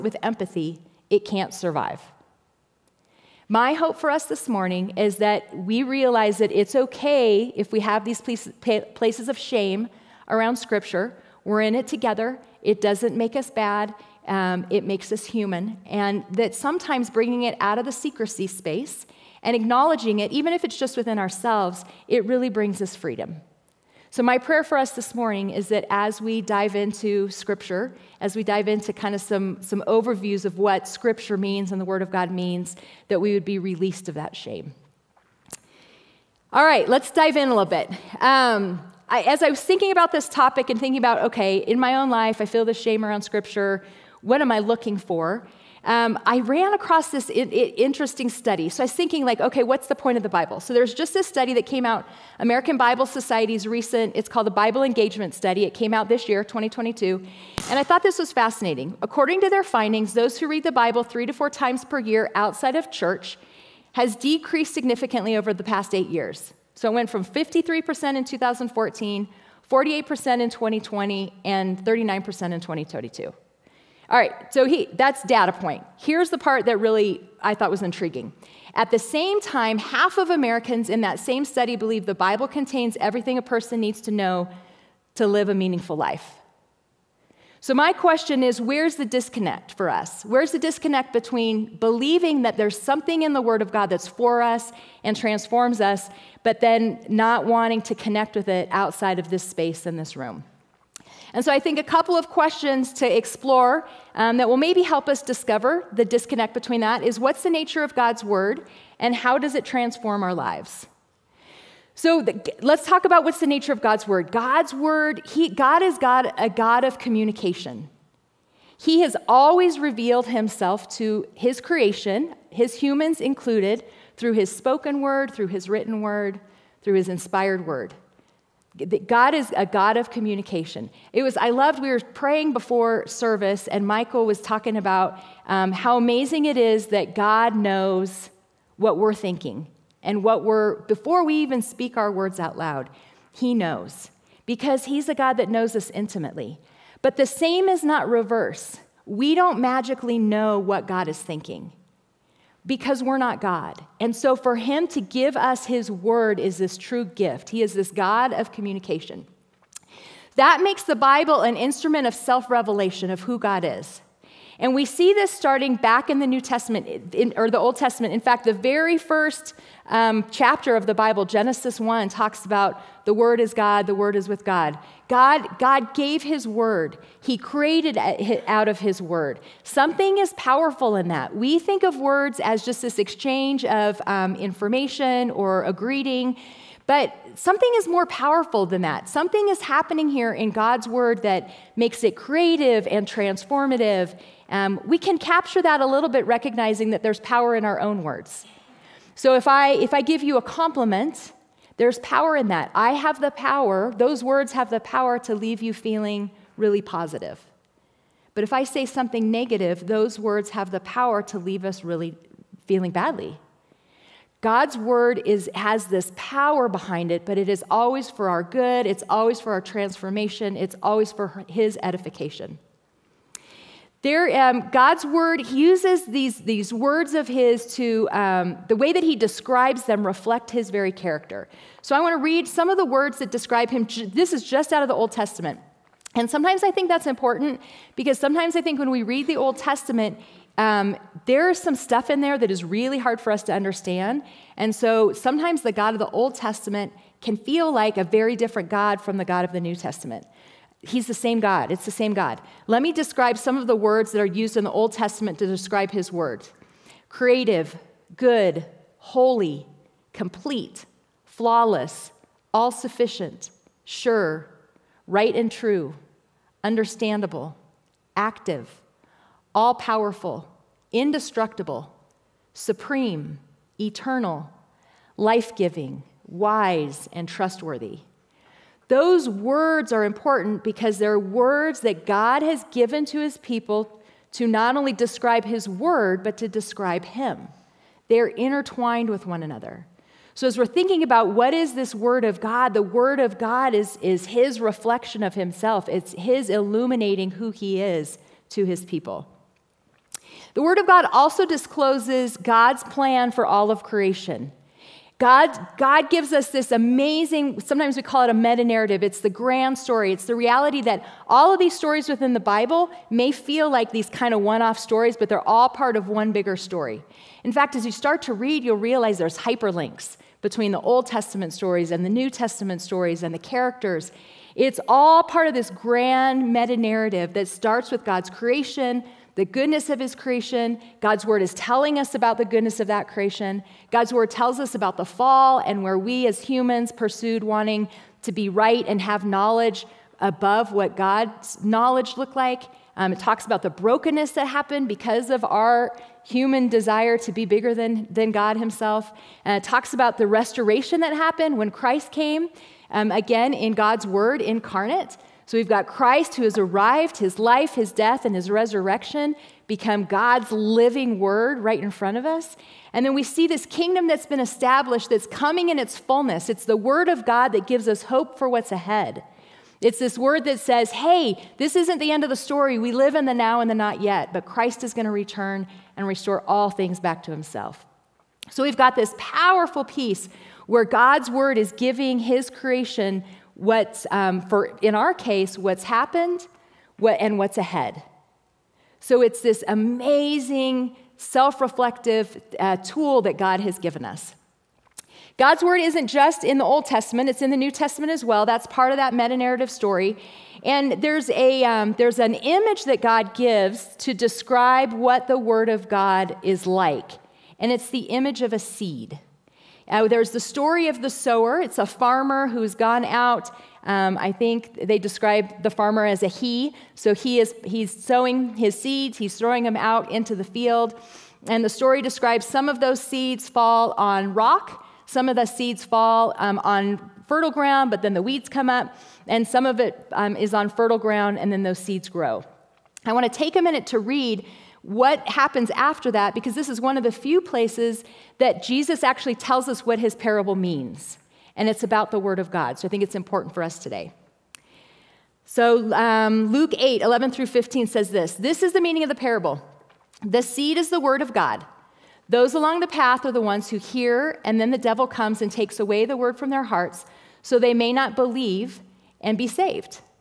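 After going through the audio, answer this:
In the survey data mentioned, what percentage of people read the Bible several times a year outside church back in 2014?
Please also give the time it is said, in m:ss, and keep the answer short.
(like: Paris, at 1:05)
53%, at 1:07.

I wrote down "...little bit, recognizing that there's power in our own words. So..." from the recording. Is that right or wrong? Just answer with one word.
right.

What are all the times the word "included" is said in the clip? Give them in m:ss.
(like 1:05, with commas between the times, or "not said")
2:03.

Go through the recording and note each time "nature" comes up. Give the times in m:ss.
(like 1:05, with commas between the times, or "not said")
1:47, 1:53.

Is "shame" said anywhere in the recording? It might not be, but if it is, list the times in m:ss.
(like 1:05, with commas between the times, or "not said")
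0:09, 0:34, 0:42.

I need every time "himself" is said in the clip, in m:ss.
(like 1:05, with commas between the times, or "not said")
2:00, 4:55, 5:48, 6:17.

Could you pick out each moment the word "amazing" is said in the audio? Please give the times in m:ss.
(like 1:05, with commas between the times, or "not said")
2:15, 5:06, 6:29.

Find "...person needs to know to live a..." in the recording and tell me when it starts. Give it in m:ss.
1:23.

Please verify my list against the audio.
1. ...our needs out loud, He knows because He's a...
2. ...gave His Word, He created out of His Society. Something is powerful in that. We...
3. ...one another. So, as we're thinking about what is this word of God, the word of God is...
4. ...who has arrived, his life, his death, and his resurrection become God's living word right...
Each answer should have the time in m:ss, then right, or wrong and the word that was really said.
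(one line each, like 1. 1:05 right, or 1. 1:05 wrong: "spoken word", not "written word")
1. 2:21 wrong: "words", not "needs"
2. 2:55 wrong: "Word", not "Society"
3. 4:49 right
4. 5:56 right.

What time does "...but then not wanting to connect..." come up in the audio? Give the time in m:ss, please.
1:36.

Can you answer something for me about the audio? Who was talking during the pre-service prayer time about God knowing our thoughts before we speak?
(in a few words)
Michael.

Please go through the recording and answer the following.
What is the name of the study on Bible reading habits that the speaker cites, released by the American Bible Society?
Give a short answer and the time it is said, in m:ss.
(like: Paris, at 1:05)
Bible Engagement Study, at 0:54.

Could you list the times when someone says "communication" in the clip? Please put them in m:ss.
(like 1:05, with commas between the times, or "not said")
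1:56, 2:10, 2:38.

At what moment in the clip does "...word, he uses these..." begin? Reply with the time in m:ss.
3:45.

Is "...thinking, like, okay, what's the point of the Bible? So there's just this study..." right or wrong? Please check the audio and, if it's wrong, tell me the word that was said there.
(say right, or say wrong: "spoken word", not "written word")
right.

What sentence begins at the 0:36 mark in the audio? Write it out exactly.
All right, let's dive in a little bit.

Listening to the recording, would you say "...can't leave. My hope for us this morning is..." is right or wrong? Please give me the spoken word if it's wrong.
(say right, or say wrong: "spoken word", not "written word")
wrong: "survive", not "leave".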